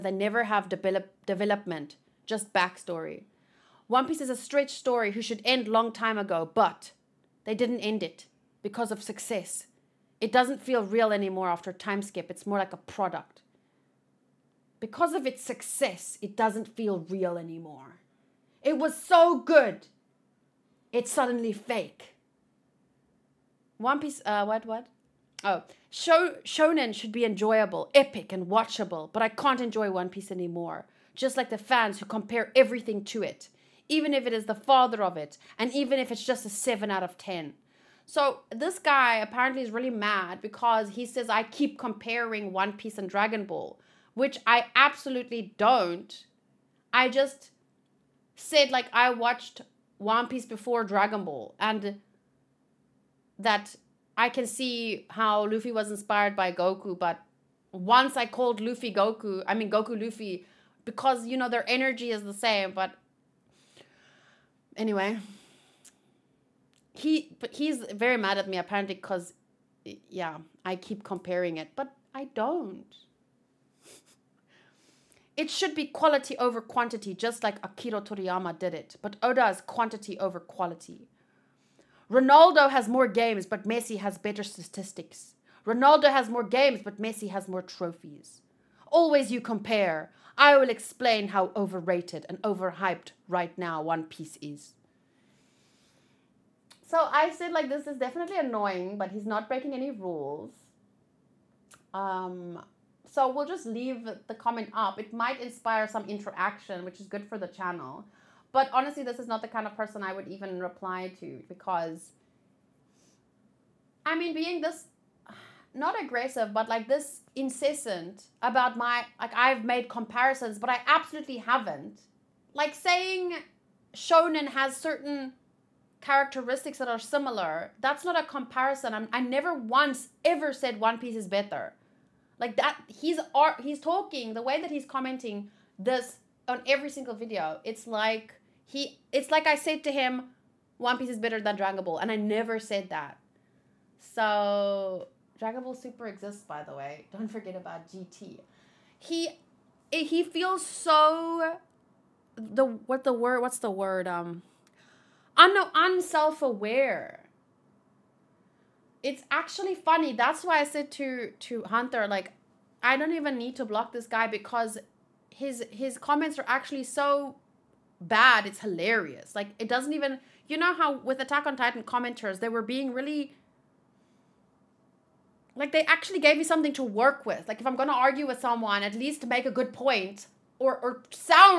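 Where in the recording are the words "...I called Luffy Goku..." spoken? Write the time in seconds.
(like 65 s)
58 s.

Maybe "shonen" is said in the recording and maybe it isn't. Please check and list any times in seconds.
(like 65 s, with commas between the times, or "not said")
26 s, 123 s.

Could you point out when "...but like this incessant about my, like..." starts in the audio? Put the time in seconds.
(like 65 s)
116 s.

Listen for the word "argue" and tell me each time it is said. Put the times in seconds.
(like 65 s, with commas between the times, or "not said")
177 s.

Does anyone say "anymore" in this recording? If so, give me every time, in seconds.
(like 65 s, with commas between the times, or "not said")
11 s, 17 s, 30 s.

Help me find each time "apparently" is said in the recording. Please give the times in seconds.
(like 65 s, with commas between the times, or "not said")
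39 s, 68 s.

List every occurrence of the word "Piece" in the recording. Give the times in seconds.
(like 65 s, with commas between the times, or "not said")
4 s, 24 s, 30 s, 42 s, 50 s, 94 s, 130 s, 140 s.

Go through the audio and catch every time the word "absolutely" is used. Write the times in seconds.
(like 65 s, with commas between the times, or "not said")
44 s, 120 s.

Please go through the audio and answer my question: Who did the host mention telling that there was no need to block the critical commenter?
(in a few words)
Hunter.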